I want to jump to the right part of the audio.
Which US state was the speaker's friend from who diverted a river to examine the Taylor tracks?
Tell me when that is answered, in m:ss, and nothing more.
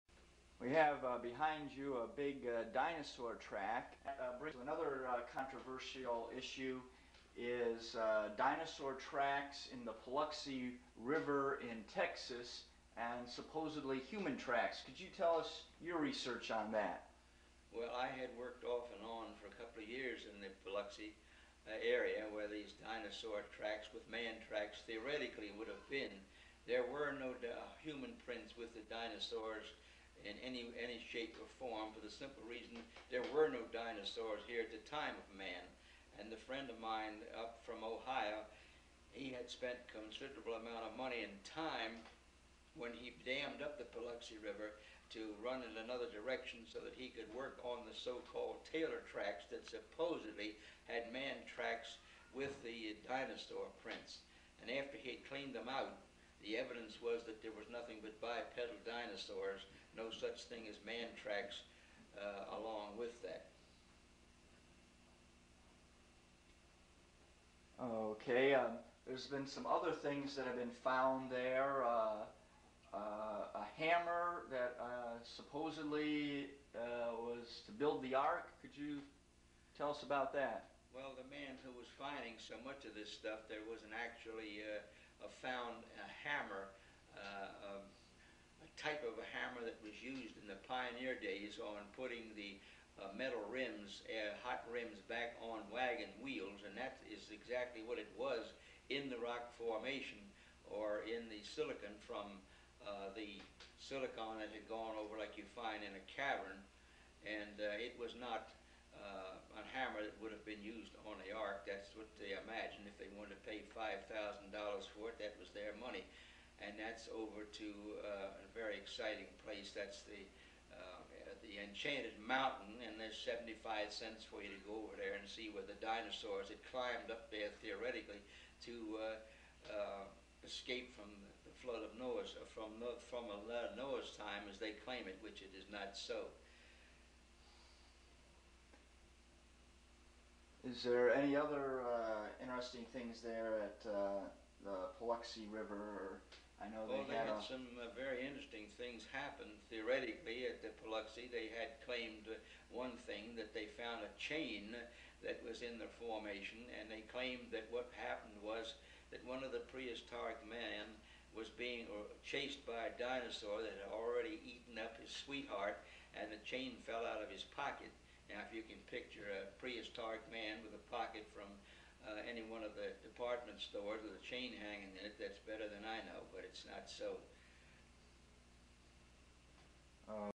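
0:37.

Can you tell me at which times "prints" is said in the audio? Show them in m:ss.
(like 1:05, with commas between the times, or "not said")
0:28, 0:53.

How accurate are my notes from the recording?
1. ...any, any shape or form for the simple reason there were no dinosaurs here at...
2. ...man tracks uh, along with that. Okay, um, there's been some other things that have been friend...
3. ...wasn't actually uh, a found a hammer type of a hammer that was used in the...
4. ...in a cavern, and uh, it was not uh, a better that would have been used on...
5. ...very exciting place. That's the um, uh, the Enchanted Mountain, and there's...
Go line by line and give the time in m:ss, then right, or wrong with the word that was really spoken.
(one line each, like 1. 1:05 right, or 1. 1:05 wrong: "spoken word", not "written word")
1. 0:30 right
2. 1:00 wrong: "found", not "friend"
3. 1:23 right
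4. 1:45 wrong: "hammer", not "better"
5. 1:58 right.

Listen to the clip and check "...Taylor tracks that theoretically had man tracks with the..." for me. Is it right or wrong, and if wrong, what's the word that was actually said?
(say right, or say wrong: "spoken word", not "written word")
wrong: "supposedly", not "theoretically".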